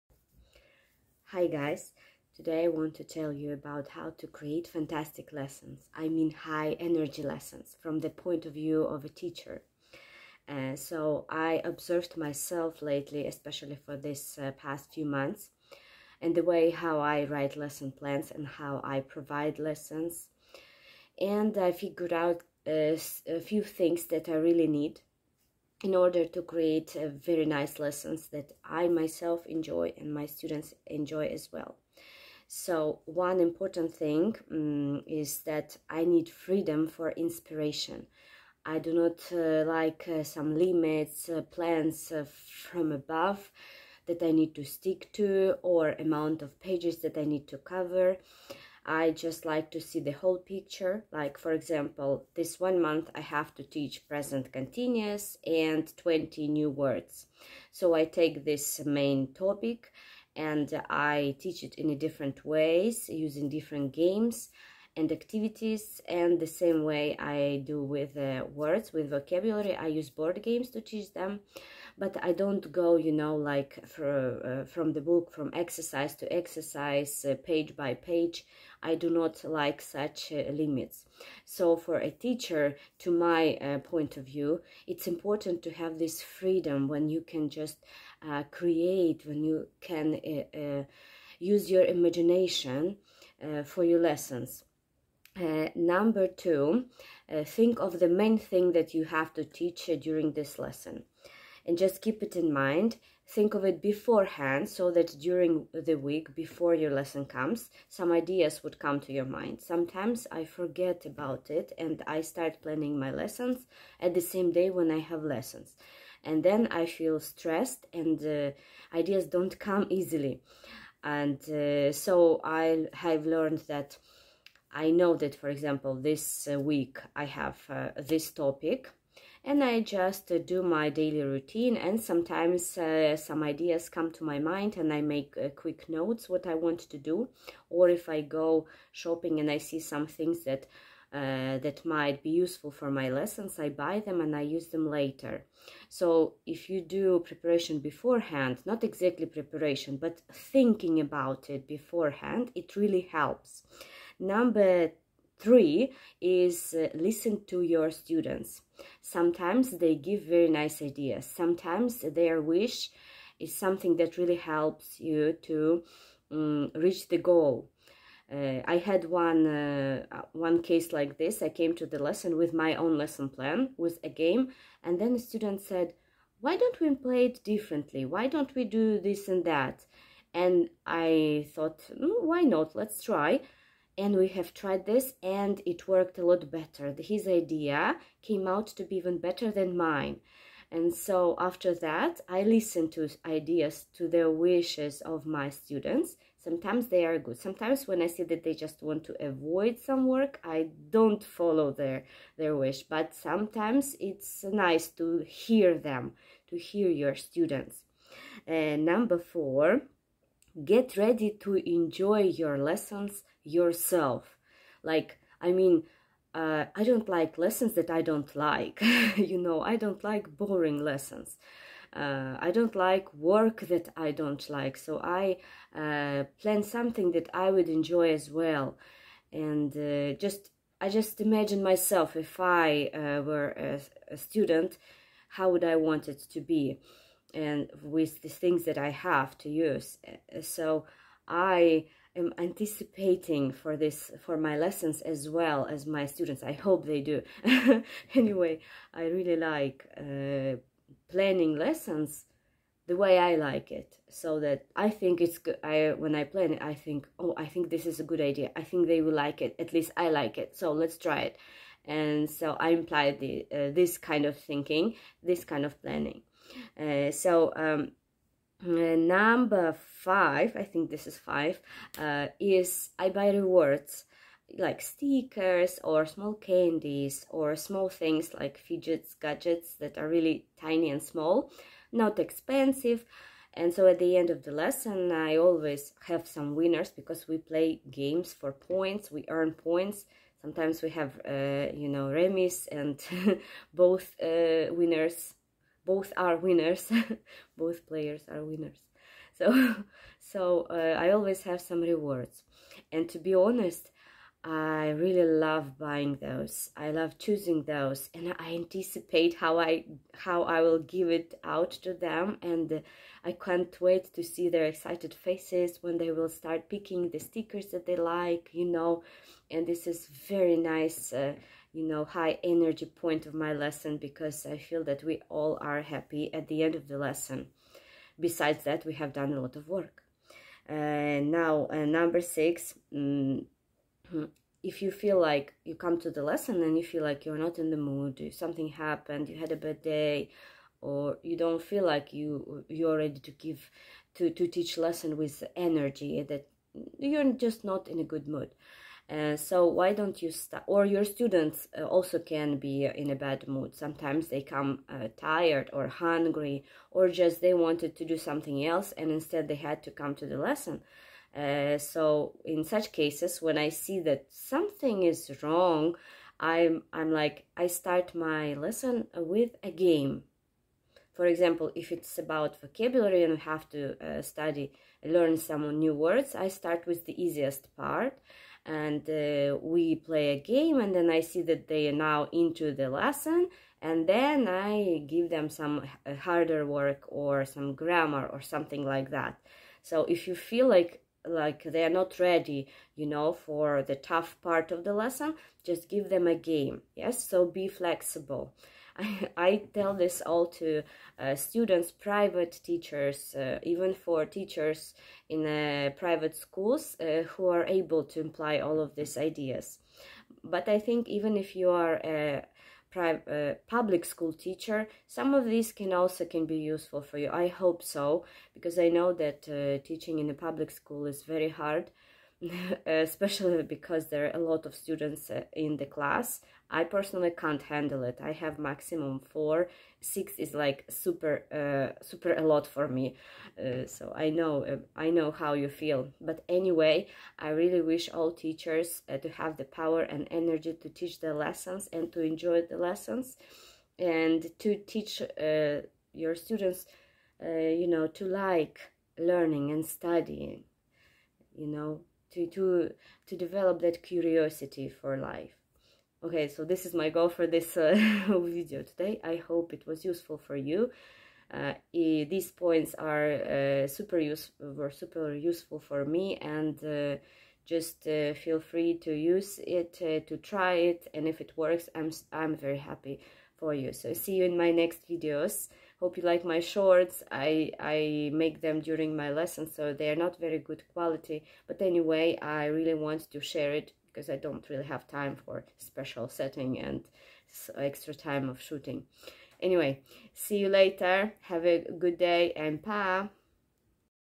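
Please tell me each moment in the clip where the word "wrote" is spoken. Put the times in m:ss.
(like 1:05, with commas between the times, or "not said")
not said.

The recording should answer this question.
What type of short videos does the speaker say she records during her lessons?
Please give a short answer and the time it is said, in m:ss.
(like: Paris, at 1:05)
shorts, at 7:56.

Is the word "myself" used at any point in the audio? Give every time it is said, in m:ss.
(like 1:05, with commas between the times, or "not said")
0:12, 0:28, 3:51.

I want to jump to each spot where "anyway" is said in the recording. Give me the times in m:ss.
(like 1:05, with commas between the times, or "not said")
4:08, 7:16, 8:01, 8:09.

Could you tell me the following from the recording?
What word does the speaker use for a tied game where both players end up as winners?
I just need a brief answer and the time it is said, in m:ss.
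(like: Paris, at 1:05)
remis, at 4:52.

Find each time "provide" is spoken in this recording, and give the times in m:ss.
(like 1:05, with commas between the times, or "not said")
0:18.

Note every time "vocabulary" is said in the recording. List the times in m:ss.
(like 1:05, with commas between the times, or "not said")
1:09, 6:12.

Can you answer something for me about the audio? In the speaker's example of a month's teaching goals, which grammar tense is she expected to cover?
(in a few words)
present continuous.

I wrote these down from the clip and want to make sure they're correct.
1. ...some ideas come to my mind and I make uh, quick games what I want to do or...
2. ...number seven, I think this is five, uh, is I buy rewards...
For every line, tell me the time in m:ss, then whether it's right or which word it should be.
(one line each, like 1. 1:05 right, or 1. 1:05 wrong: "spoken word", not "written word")
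1. 2:13 wrong: "notes", not "games"
2. 4:28 wrong: "five", not "seven".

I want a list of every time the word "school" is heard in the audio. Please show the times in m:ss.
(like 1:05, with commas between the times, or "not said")
6:46, 6:54, 7:00.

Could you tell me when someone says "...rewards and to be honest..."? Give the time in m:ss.
5:01.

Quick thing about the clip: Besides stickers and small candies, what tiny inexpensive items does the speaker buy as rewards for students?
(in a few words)
fidgets.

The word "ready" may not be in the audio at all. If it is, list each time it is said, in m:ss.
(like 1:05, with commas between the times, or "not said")
3:30, 5:42, 6:32.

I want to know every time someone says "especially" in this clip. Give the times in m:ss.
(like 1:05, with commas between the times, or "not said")
0:13, 7:02.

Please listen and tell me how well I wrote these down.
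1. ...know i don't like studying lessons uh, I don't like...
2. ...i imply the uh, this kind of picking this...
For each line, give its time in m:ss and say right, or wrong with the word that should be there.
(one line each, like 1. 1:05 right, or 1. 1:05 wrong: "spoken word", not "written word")
1. 3:39 wrong: "boring", not "studying"
2. 4:22 wrong: "thinking", not "picking".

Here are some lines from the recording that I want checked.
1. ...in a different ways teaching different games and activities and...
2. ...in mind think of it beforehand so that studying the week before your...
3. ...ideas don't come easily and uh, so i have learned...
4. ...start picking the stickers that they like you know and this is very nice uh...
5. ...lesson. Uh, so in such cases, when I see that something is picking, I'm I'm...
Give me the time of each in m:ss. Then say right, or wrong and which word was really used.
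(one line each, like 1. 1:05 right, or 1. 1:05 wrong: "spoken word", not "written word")
1. 1:01 wrong: "using", not "teaching"
2. 1:42 wrong: "during", not "studying"
3. 1:58 right
4. 5:16 right
5. 6:00 wrong: "wrong", not "picking".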